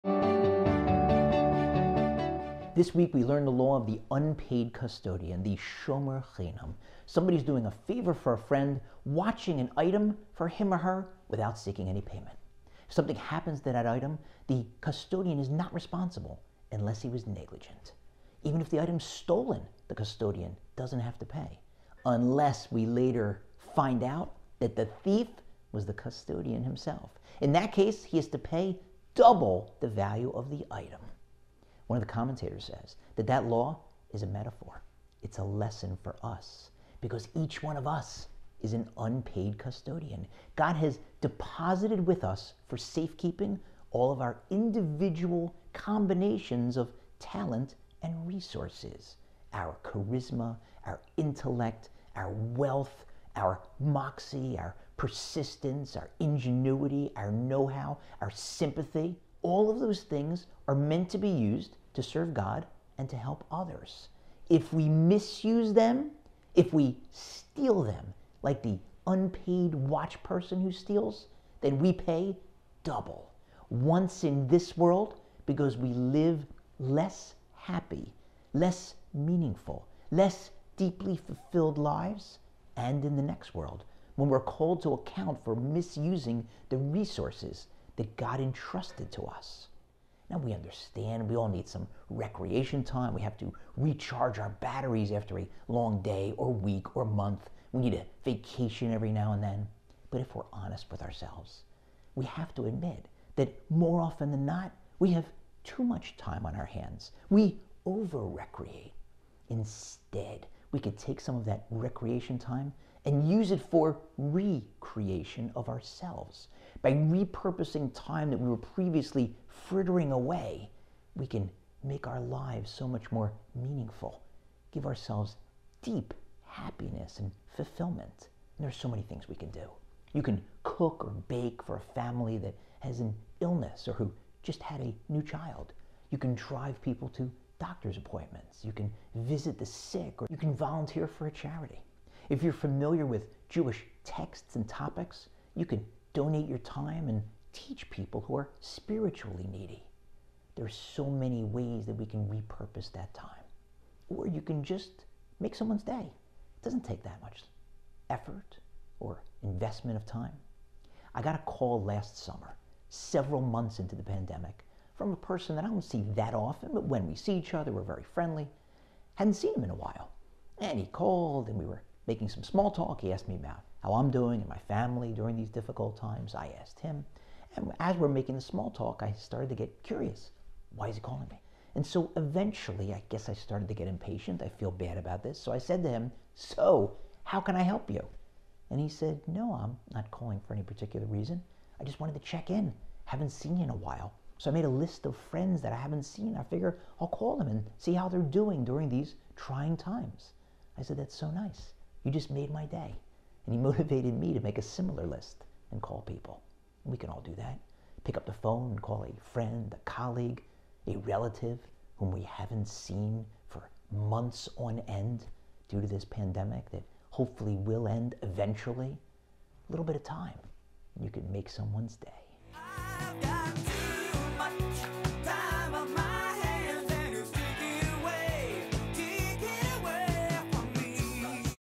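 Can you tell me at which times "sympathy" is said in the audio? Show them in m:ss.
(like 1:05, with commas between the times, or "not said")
0:58.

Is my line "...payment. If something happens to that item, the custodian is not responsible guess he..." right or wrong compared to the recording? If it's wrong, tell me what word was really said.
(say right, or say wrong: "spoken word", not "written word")
wrong: "unless", not "guess".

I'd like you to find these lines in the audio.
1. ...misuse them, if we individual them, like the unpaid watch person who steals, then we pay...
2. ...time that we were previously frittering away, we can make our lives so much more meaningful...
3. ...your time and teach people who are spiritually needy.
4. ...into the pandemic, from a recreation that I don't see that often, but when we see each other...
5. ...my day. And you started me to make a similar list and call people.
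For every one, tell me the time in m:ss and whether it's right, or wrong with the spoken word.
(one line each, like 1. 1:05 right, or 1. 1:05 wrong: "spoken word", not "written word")
1. 1:04 wrong: "steal", not "individual"
2. 1:57 right
3. 2:26 right
4. 2:43 wrong: "person", not "recreation"
5. 3:22 wrong: "motivated", not "started".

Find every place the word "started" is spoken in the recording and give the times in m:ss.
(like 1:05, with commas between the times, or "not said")
2:59, 3:03.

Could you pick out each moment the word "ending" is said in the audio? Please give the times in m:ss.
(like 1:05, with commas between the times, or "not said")
not said.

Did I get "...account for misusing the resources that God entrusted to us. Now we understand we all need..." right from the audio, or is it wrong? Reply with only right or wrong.
right.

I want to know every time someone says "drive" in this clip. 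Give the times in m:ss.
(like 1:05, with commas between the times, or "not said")
2:16.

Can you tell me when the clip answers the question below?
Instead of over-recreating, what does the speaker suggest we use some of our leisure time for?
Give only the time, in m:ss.
1:54.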